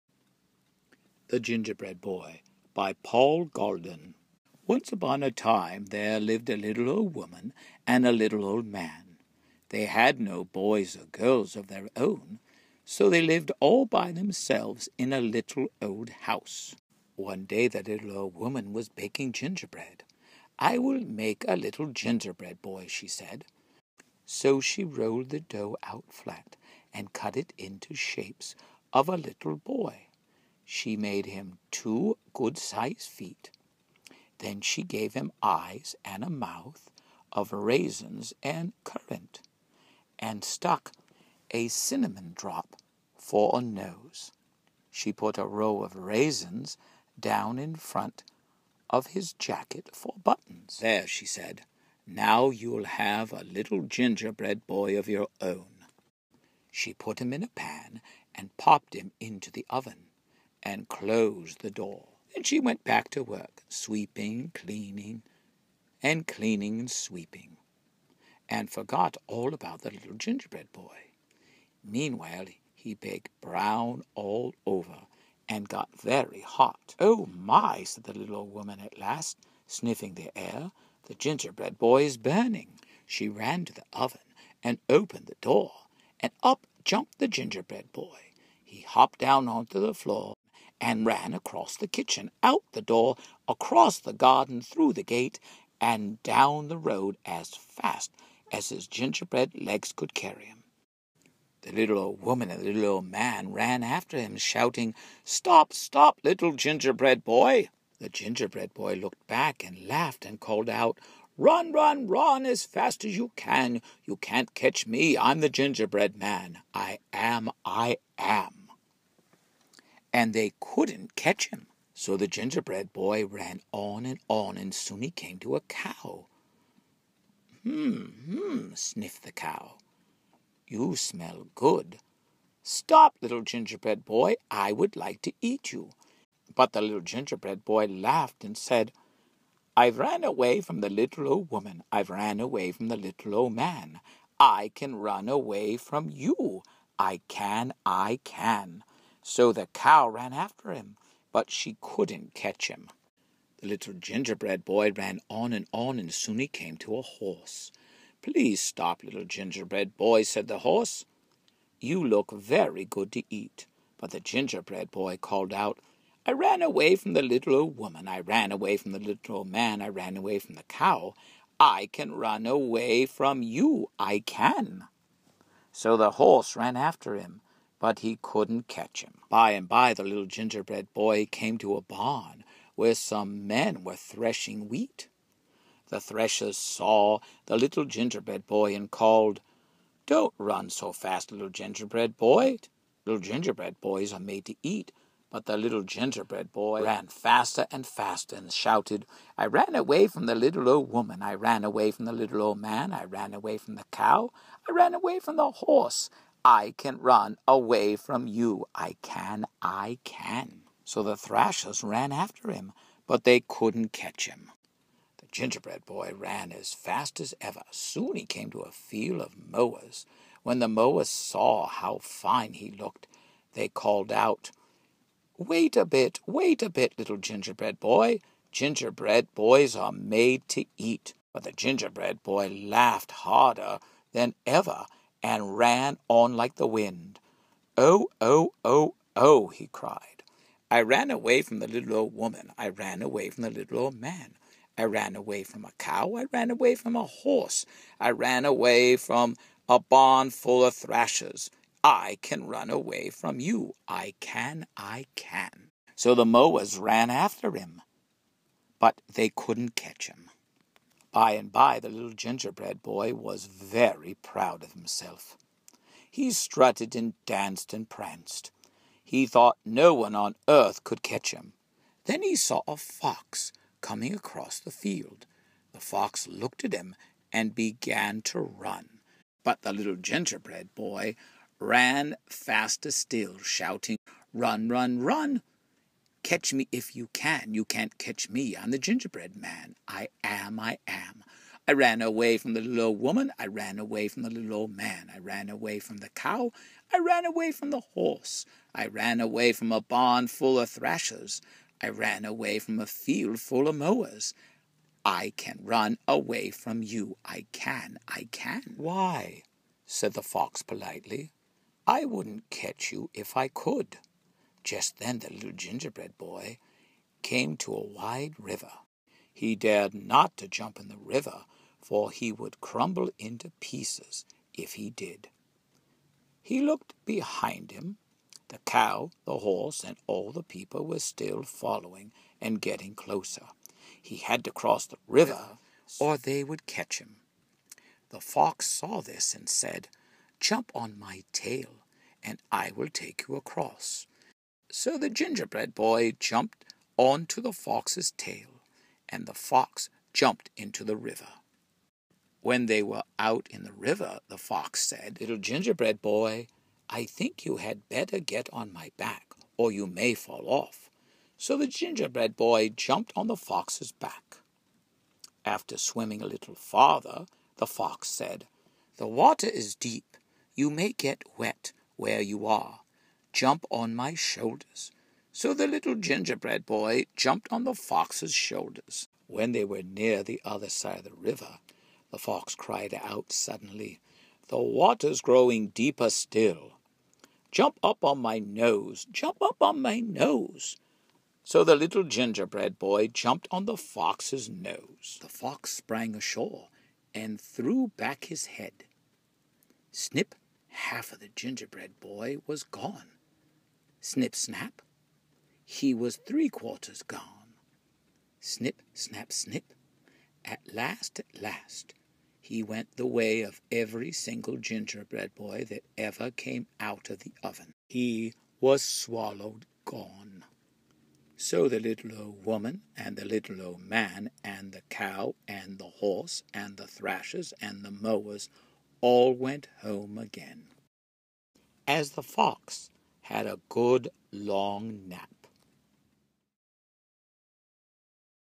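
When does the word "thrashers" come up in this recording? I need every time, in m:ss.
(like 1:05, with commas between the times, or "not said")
3:31, 4:10, 5:00, 7:06.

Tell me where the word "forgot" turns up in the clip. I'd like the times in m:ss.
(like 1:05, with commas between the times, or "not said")
1:08.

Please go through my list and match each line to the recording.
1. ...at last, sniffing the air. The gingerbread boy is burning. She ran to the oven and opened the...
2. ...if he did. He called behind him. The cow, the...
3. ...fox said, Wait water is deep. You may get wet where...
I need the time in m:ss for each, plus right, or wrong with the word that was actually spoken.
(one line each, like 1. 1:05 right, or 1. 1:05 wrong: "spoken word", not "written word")
1. 1:18 right
2. 5:24 wrong: "looked", not "called"
3. 6:07 wrong: "The", not "Wait".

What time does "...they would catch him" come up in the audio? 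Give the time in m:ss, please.
5:36.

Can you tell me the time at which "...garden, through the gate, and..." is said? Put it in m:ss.
1:34.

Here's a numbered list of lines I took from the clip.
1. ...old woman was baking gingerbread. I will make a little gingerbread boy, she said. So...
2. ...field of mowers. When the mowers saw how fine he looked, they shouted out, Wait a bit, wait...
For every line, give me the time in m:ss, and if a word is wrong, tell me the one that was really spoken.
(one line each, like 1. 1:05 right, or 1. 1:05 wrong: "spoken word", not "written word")
1. 0:18 right
2. 3:38 wrong: "called", not "shouted".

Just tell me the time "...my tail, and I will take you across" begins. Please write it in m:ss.
5:40.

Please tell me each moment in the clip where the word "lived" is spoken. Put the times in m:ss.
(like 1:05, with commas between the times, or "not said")
0:06, 0:13.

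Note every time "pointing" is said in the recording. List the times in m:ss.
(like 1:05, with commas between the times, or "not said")
not said.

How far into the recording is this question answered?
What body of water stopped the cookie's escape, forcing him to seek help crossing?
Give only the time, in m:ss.
5:17.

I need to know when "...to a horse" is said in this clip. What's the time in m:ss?
2:36.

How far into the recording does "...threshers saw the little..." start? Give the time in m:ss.
3:05.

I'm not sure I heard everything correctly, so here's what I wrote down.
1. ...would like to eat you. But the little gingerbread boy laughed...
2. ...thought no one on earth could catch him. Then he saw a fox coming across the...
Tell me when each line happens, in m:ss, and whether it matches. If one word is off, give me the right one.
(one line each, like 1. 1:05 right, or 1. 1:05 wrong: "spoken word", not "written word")
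1. 2:14 right
2. 4:29 right.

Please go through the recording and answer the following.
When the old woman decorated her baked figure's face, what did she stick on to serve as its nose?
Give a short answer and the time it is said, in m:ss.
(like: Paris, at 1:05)
a cinnamon drop, at 0:41.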